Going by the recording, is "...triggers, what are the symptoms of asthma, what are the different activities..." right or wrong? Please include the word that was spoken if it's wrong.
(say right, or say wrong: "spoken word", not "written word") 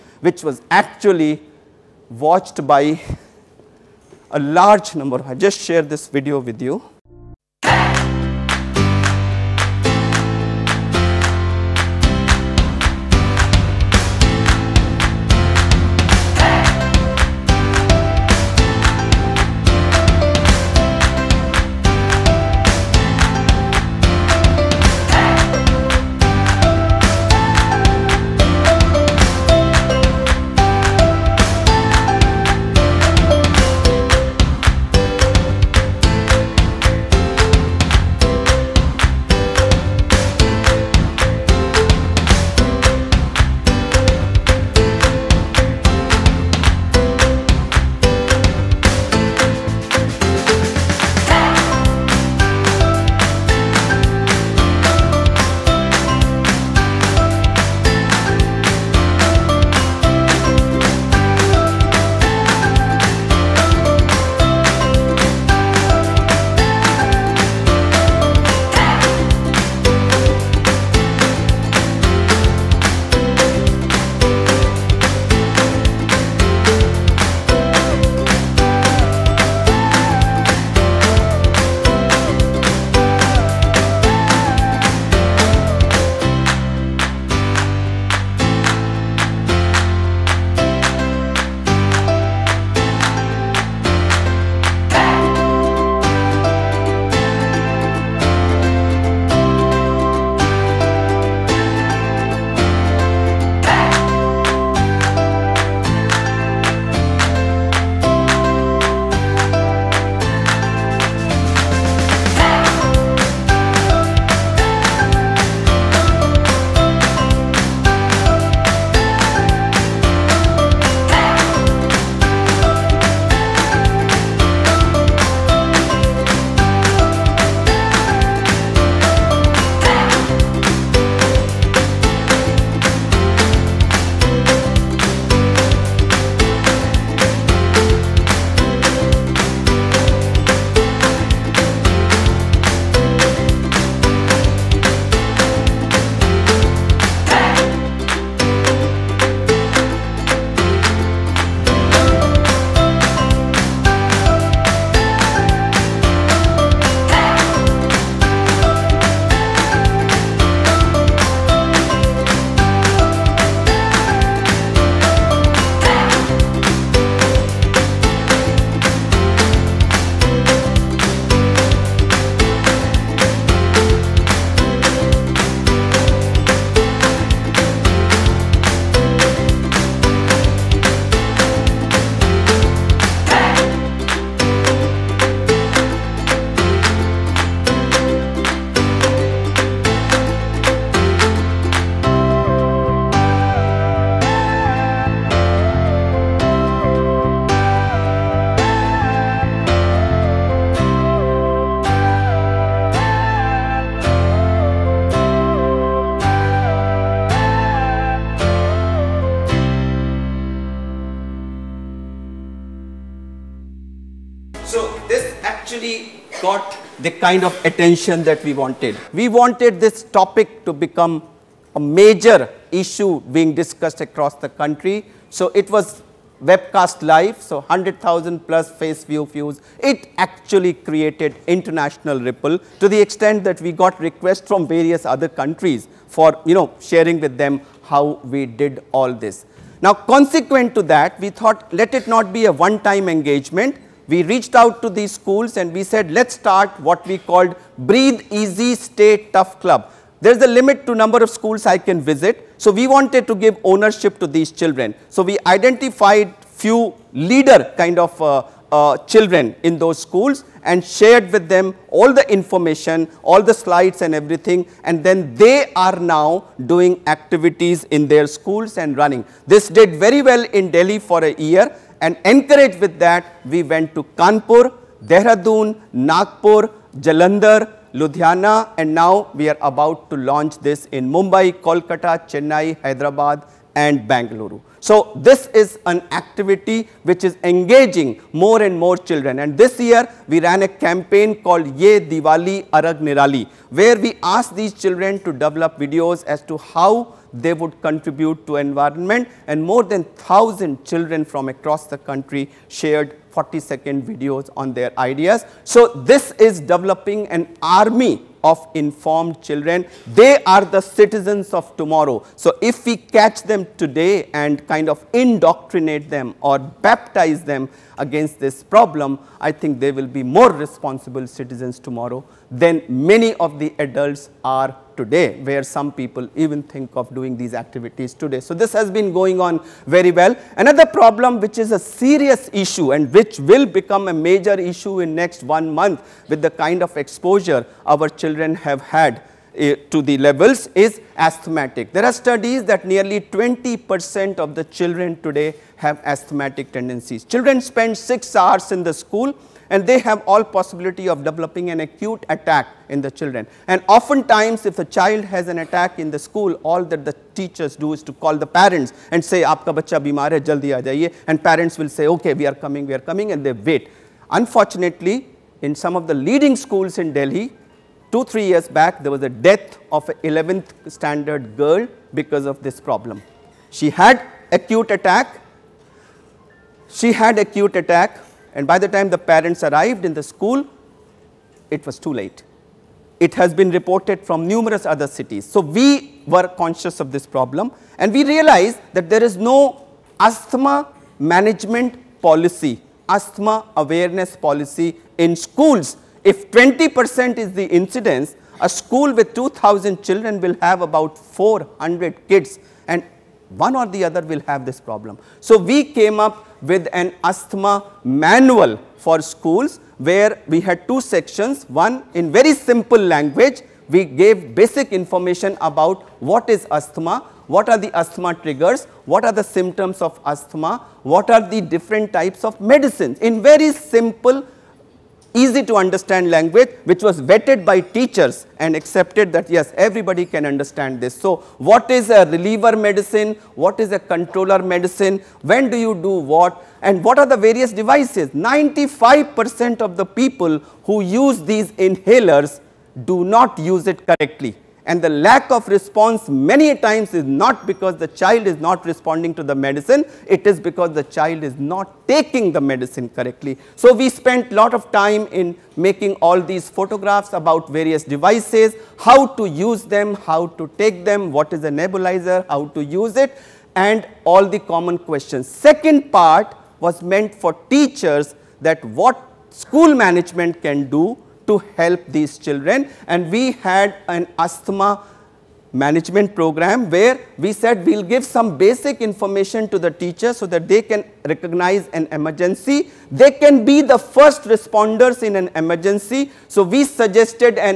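wrong: "types", not "activities".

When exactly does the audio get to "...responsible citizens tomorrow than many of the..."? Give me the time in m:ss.
5:20.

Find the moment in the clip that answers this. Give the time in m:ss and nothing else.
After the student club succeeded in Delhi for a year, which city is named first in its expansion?
4:34.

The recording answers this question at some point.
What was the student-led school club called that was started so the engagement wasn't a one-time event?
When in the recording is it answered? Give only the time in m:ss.
4:07.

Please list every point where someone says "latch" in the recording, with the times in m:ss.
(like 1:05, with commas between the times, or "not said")
not said.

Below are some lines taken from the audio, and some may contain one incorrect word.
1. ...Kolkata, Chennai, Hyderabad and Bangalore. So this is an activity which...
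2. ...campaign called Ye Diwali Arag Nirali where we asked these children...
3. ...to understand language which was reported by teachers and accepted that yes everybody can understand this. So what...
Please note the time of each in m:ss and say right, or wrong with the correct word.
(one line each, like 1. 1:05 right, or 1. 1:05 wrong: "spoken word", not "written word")
1. 4:41 right
2. 4:50 right
3. 7:05 wrong: "vetted", not "reported".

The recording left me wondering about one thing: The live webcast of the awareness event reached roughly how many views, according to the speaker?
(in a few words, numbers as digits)
100,000 plus.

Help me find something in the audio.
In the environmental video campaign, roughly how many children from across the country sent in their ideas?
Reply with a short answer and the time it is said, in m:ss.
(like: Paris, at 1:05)
more than 1000, at 4:59.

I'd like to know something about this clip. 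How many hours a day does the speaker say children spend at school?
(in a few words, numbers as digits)
6 hours.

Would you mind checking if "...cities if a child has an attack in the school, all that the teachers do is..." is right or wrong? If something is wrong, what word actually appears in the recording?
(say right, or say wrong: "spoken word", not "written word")
wrong: "oftentimes", not "cities".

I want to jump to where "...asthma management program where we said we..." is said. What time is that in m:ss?
7:54.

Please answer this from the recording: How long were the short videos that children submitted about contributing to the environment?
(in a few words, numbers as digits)
40 seconds.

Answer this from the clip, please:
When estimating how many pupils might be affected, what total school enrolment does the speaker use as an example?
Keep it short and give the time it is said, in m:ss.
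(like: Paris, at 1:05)
2000, at 6:39.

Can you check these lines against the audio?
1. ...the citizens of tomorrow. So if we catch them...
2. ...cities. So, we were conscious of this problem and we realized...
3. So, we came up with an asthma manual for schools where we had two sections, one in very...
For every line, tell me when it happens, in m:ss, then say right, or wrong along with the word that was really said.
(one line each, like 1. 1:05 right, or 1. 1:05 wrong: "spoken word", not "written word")
1. 5:10 right
2. 6:25 right
3. 6:45 right.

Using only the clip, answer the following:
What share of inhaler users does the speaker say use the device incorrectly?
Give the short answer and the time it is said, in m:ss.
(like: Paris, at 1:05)
95%, at 7:18.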